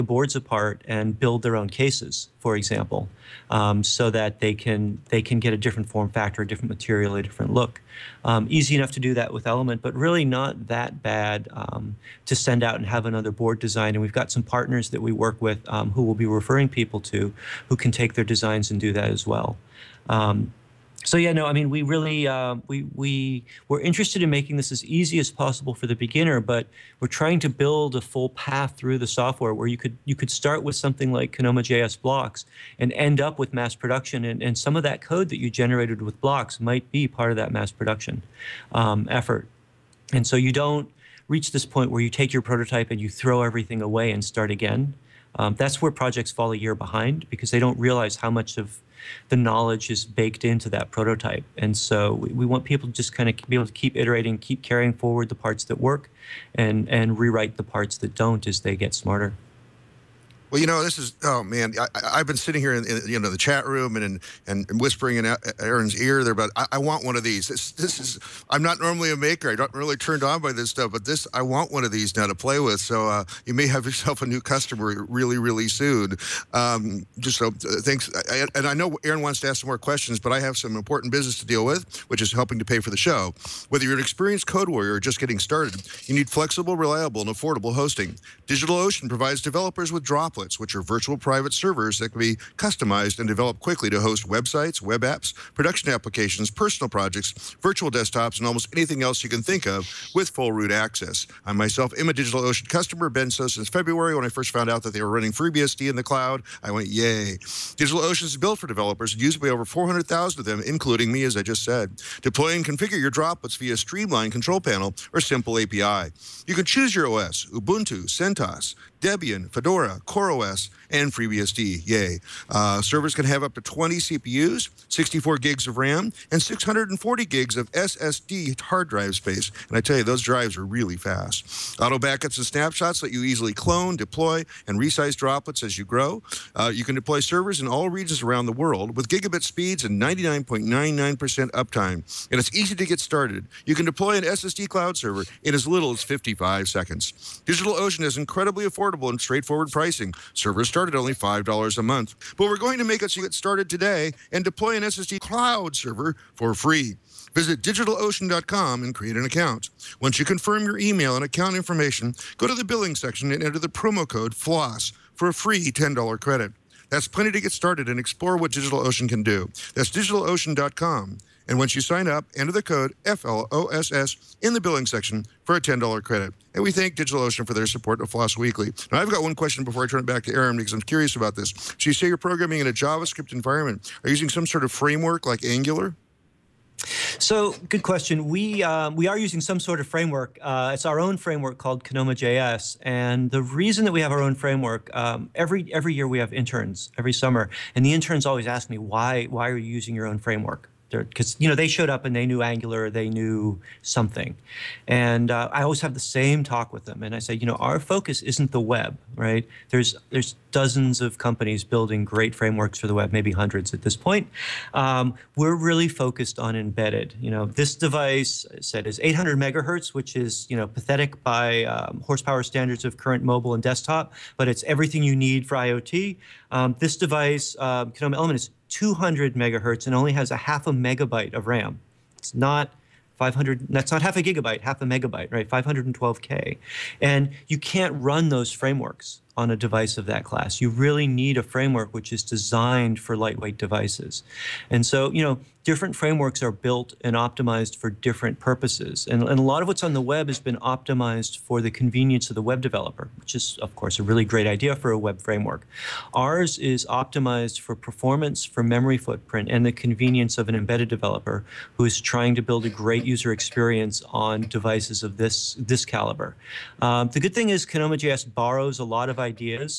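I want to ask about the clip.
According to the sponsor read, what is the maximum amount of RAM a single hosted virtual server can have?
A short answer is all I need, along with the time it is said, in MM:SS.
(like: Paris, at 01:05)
64 GB, at 02:04.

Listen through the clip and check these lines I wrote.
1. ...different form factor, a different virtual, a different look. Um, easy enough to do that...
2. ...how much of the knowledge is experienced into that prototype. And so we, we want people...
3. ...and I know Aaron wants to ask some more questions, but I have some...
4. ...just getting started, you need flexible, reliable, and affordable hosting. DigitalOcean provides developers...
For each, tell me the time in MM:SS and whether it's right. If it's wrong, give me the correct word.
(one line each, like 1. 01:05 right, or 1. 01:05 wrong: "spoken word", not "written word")
1. 00:05 wrong: "material", not "virtual"
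2. 00:48 wrong: "baked", not "experienced"
3. 01:18 right
4. 01:25 right.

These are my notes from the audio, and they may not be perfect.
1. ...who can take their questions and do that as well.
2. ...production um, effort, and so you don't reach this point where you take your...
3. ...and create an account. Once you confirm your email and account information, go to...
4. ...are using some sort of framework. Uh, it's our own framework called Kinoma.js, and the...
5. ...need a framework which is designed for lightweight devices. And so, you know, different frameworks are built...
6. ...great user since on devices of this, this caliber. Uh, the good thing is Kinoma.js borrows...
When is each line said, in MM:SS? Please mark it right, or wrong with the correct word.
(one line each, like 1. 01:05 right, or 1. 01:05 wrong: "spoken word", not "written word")
1. 00:17 wrong: "designs", not "questions"
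2. 00:37 right
3. 02:38 right
4. 03:09 right
5. 04:01 right
6. 04:22 wrong: "experience", not "since".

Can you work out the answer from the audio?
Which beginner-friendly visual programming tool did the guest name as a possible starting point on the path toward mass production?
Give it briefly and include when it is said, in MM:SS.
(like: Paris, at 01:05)
Kinoma JS blocks, at 00:31.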